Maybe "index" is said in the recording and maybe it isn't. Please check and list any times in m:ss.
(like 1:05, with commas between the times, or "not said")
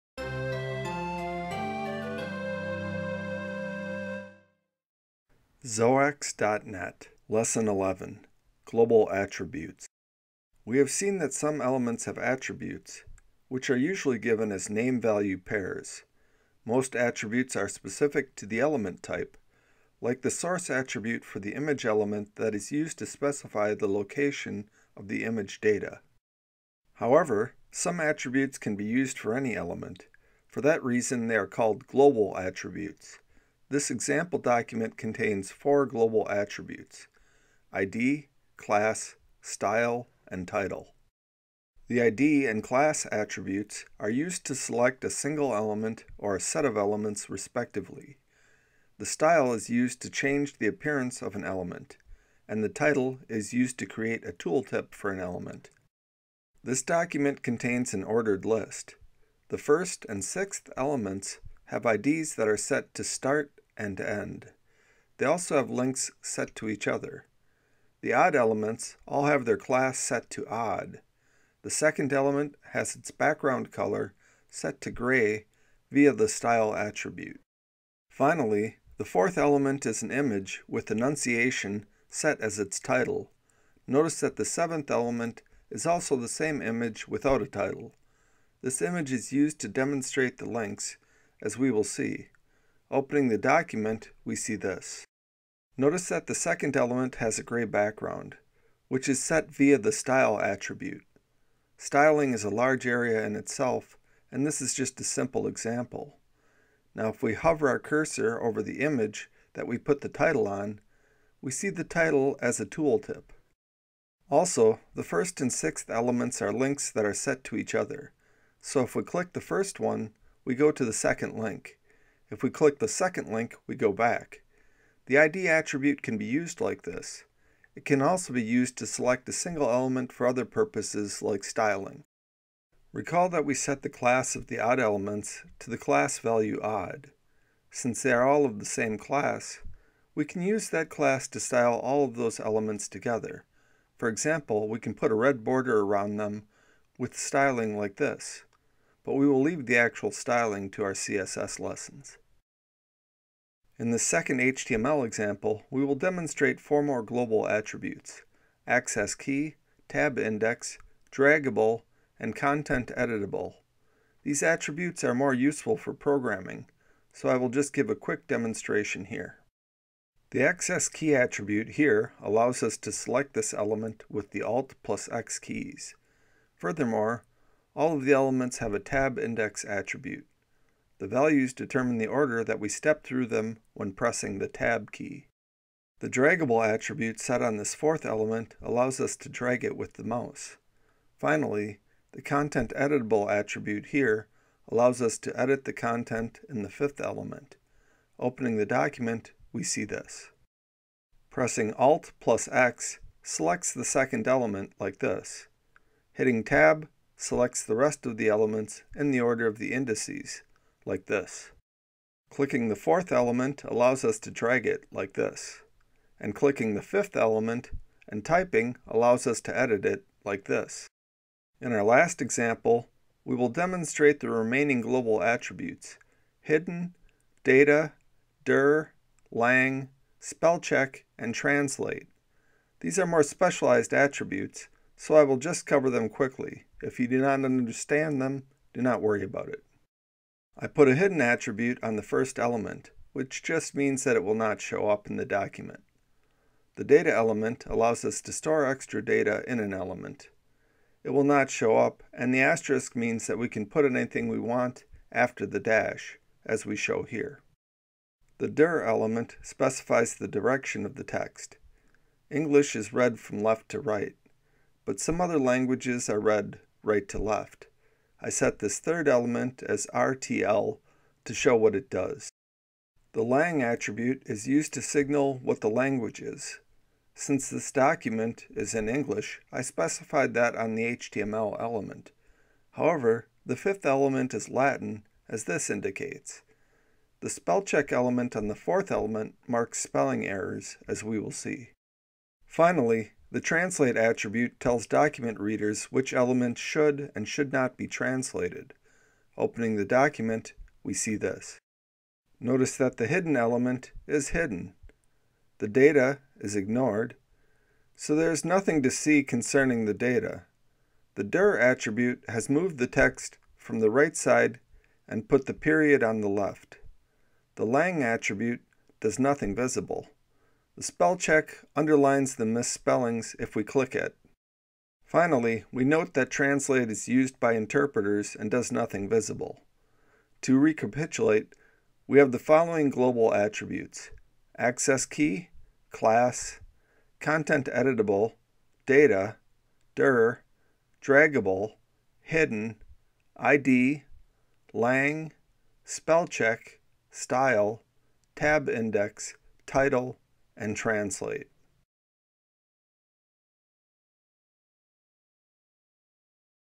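2:40, 2:59, 5:48.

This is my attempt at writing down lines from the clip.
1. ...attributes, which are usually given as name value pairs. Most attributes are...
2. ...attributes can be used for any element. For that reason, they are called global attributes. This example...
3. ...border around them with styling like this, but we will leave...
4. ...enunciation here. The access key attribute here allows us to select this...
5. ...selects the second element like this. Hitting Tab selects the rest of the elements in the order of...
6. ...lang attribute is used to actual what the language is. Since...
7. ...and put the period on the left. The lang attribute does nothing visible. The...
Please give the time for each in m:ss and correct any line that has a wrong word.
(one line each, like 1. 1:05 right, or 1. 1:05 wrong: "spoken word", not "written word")
1. 0:12 right
2. 0:27 right
3. 2:25 right
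4. 2:48 wrong: "demonstration", not "enunciation"
5. 3:23 right
6. 4:33 wrong: "signal", not "actual"
7. 5:15 right.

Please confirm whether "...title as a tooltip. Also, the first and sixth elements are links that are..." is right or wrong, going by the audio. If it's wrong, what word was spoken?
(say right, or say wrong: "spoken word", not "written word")
right.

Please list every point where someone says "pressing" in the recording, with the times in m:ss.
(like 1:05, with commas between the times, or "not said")
3:03, 3:21.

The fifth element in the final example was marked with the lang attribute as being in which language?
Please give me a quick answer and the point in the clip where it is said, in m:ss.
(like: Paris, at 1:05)
Latin, at 4:44.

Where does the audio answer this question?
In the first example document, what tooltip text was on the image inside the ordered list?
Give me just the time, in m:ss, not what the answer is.
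1:20.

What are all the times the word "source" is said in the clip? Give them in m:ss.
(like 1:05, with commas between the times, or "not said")
0:20.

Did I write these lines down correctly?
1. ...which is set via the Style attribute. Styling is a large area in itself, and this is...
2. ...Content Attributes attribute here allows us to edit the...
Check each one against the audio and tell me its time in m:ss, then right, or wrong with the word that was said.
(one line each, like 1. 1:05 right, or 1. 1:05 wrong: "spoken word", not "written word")
1. 1:38 right
2. 3:12 wrong: "Editable", not "Attributes".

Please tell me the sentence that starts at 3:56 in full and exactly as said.
If you do not understand them, do not worry about it.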